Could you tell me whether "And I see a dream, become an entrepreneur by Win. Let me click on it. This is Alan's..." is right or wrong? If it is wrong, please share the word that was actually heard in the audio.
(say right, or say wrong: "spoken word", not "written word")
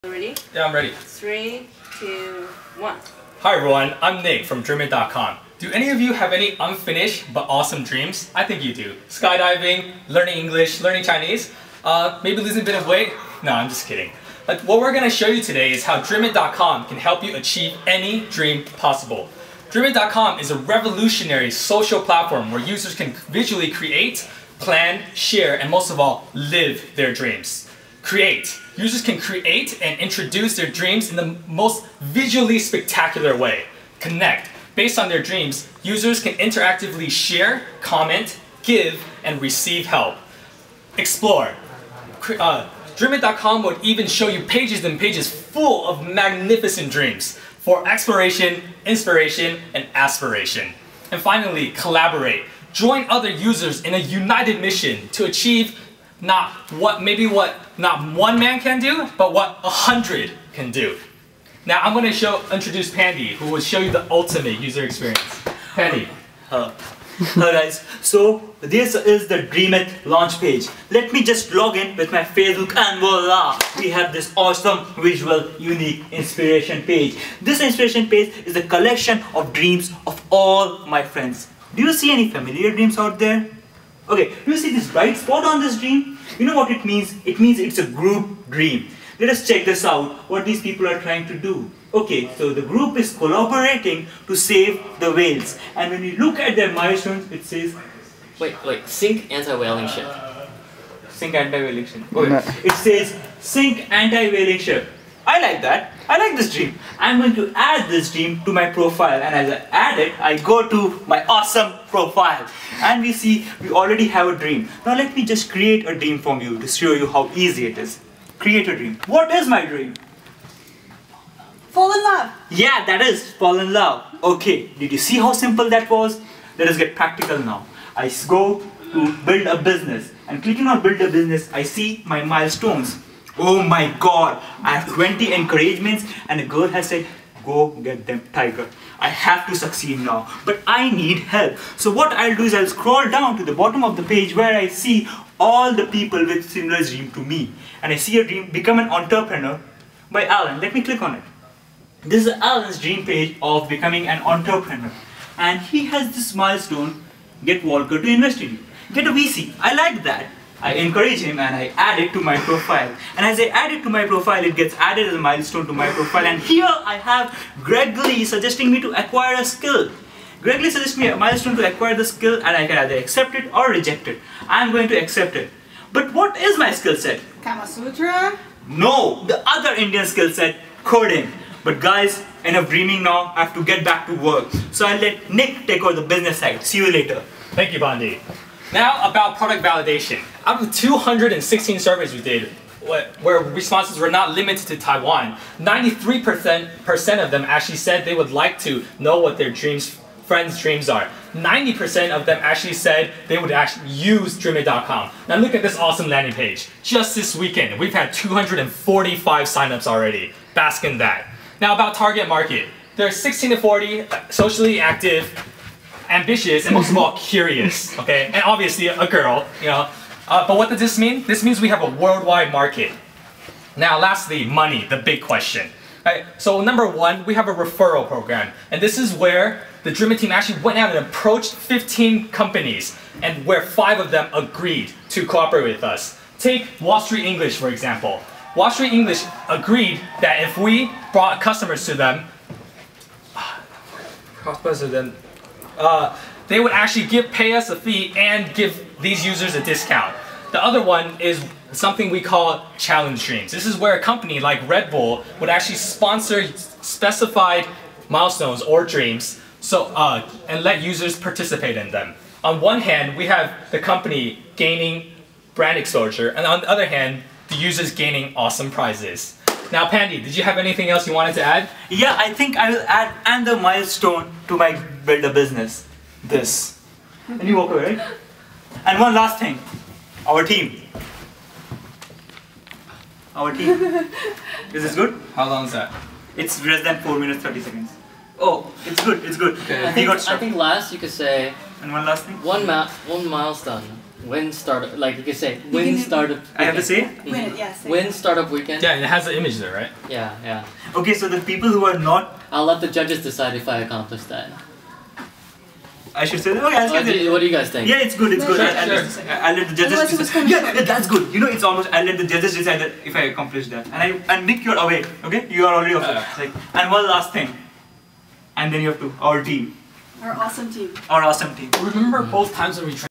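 wrong: "Alan", not "Win".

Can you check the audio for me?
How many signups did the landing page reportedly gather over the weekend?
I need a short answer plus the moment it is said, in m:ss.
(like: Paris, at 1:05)
245, at 3:28.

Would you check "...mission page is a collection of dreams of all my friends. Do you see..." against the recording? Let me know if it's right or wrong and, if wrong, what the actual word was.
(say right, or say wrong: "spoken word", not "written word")
wrong: "inspiration", not "mission".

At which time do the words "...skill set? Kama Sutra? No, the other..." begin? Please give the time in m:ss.
2:56.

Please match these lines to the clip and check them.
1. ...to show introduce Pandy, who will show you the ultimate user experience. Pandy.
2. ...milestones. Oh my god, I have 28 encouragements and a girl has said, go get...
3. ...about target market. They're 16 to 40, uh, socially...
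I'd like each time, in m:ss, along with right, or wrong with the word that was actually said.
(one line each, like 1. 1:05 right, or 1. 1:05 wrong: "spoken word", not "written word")
1. 1:02 right
2. 2:12 wrong: "20", not "28"
3. 3:31 right.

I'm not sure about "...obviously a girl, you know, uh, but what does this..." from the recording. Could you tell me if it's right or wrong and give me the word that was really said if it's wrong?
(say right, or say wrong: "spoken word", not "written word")
right.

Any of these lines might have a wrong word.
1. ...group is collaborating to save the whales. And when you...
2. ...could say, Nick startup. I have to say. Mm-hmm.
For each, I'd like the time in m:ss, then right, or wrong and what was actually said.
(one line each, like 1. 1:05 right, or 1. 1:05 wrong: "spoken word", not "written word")
1. 1:32 right
2. 4:55 wrong: "Win", not "Nick".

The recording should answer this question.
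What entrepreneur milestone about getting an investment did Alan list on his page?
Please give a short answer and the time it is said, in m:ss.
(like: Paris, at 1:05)
Get Walker to invest in you, at 2:37.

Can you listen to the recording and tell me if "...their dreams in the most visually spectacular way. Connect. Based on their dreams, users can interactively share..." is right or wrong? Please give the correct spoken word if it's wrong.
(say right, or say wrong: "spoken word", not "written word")
right.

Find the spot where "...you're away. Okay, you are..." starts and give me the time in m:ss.
5:14.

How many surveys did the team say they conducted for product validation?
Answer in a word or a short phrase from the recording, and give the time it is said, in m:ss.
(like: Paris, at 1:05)
216, at 3:10.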